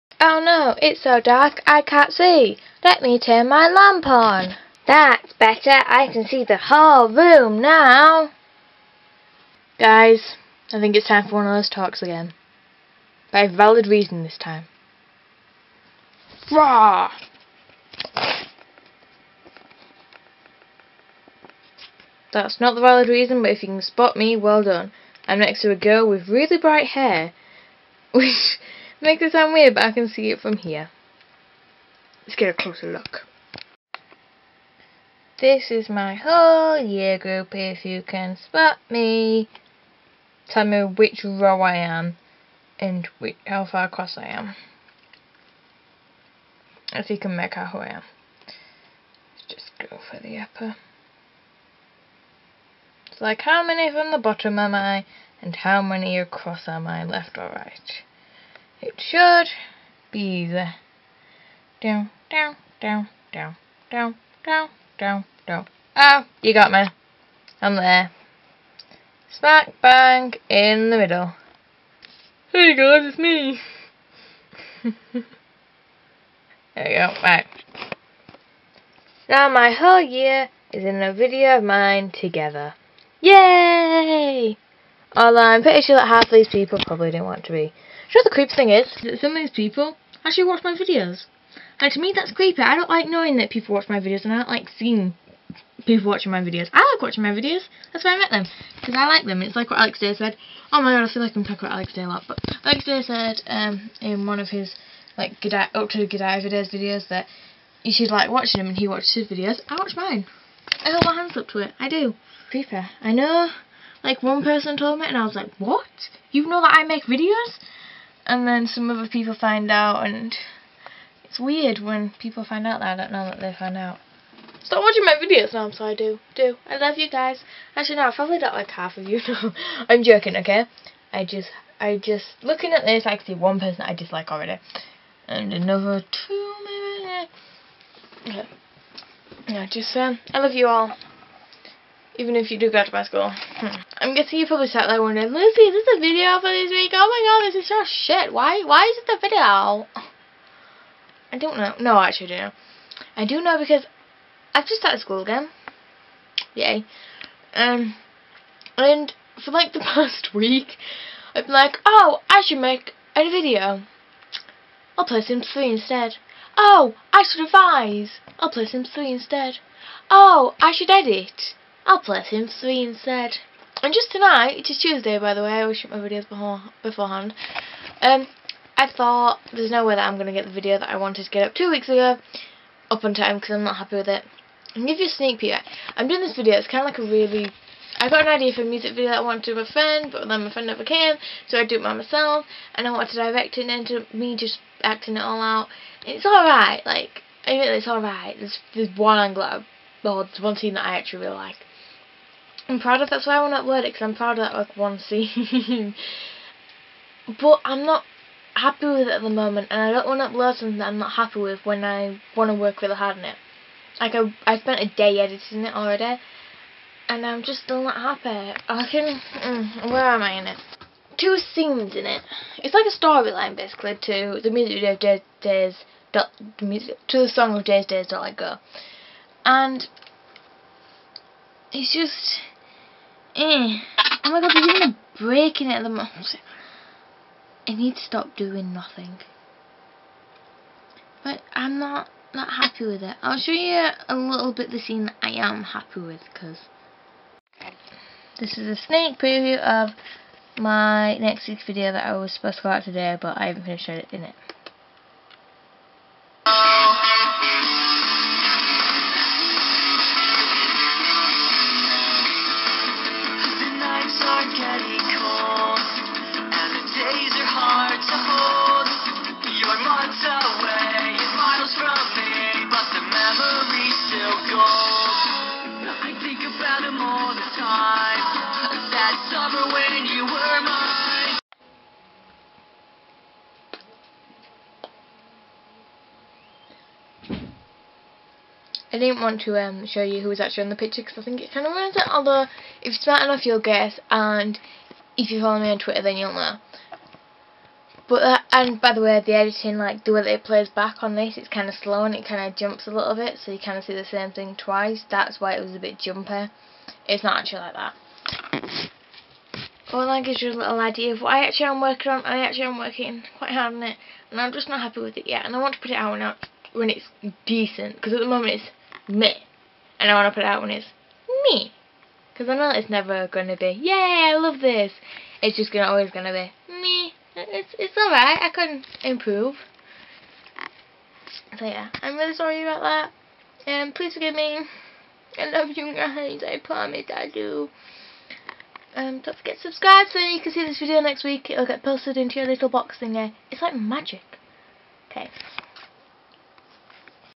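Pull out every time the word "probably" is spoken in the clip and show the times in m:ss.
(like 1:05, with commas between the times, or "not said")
1:26, 2:08, 2:24.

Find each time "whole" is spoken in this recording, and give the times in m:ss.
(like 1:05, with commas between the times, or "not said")
0:06, 0:36, 1:19.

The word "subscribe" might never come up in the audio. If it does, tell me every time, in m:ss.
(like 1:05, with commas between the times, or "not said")
5:39.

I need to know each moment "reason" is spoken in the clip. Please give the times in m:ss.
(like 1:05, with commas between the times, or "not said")
0:13, 0:23.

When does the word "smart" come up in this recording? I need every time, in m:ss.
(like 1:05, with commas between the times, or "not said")
4:52.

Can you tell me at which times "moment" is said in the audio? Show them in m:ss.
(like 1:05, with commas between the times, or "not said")
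3:29, 3:55, 5:18.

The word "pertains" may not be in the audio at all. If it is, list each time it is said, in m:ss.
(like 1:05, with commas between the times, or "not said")
not said.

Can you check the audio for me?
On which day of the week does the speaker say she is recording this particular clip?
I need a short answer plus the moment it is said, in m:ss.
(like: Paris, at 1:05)
Tuesday, at 2:54.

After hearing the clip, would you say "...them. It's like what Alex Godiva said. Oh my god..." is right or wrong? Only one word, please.
wrong.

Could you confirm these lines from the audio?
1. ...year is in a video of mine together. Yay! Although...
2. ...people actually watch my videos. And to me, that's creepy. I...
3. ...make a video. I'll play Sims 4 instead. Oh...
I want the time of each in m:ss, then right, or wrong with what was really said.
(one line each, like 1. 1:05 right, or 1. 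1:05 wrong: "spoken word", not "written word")
1. 1:20 right
2. 1:29 right
3. 2:42 wrong: "3", not "4".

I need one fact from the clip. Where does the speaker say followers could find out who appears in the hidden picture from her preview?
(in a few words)
Twitter.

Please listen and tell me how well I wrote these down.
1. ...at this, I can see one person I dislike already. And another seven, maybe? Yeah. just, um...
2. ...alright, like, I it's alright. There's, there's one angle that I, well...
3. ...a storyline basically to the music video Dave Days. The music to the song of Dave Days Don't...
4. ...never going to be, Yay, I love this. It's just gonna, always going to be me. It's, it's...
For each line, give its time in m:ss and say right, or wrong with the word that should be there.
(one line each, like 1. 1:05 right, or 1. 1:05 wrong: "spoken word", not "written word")
1. 2:12 wrong: "two", not "seven"
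2. 3:16 right
3. 3:42 right
4. 5:22 right.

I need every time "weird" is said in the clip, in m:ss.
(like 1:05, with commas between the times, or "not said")
0:29, 2:01.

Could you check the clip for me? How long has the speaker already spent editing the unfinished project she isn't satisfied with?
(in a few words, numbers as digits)
a day.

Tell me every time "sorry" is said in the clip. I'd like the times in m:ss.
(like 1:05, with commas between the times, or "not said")
2:05, 5:32.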